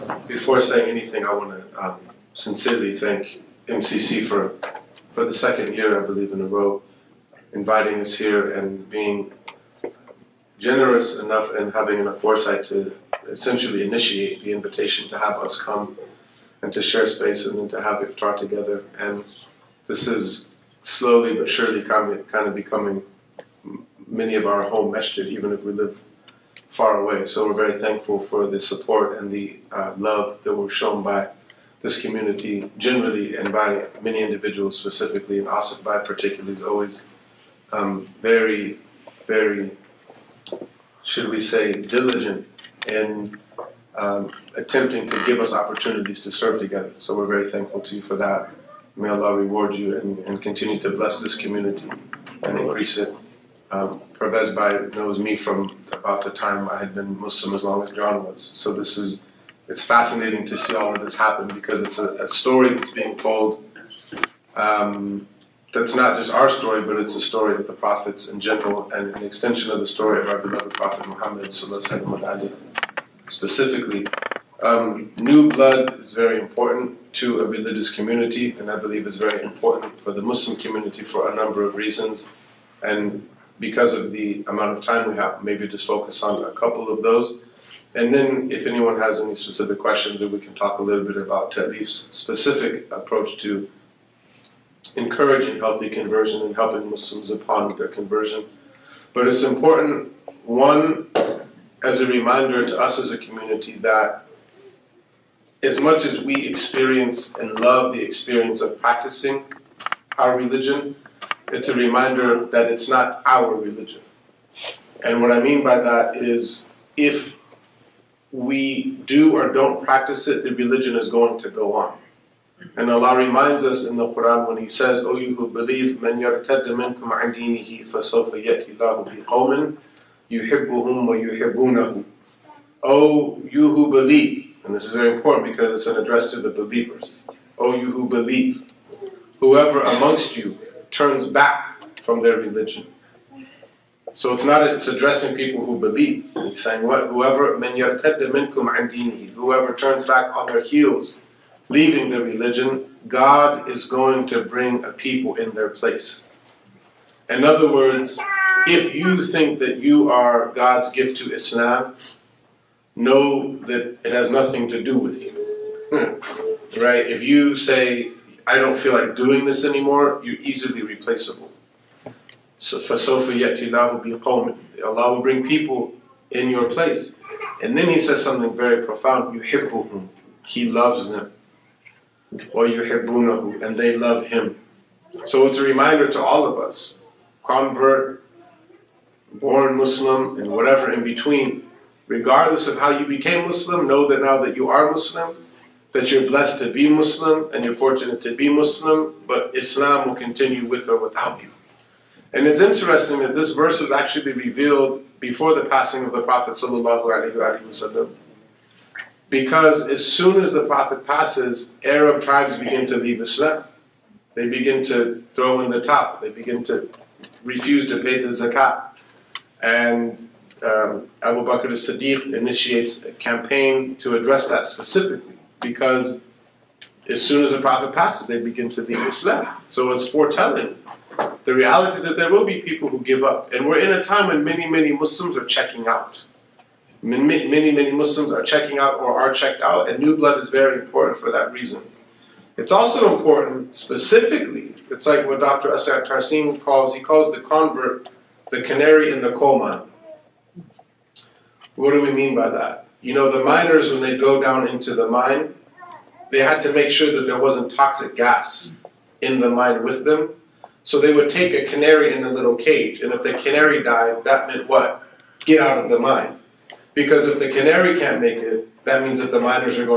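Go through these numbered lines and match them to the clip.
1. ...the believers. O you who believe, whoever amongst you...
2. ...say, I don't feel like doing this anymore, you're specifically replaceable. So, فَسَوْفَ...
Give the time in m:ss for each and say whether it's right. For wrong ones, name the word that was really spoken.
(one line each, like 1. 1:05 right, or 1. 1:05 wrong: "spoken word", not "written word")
1. 2:16 right
2. 2:47 wrong: "easily", not "specifically".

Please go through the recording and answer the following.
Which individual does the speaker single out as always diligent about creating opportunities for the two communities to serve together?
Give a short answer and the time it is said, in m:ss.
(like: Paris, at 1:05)
Asif Bhai, at 0:35.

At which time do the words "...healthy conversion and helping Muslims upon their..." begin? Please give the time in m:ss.
1:35.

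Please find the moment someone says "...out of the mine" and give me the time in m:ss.
4:25.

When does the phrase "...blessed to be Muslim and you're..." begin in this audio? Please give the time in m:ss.
3:16.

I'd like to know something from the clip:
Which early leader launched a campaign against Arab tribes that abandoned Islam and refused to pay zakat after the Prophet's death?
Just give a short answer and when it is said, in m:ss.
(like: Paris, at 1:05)
Abu Bakr as-Siddiq, at 3:41.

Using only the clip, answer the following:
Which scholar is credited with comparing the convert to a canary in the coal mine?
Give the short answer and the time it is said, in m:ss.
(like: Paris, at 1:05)
Dr. Asad Tarsin, at 4:05.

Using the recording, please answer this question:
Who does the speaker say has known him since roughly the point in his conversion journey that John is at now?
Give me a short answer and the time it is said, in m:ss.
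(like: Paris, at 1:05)
Pervez Bhai, at 0:54.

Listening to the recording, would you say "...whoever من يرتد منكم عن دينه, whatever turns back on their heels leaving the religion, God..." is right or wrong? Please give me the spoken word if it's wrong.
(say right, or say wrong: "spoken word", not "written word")
wrong: "whoever", not "whatever".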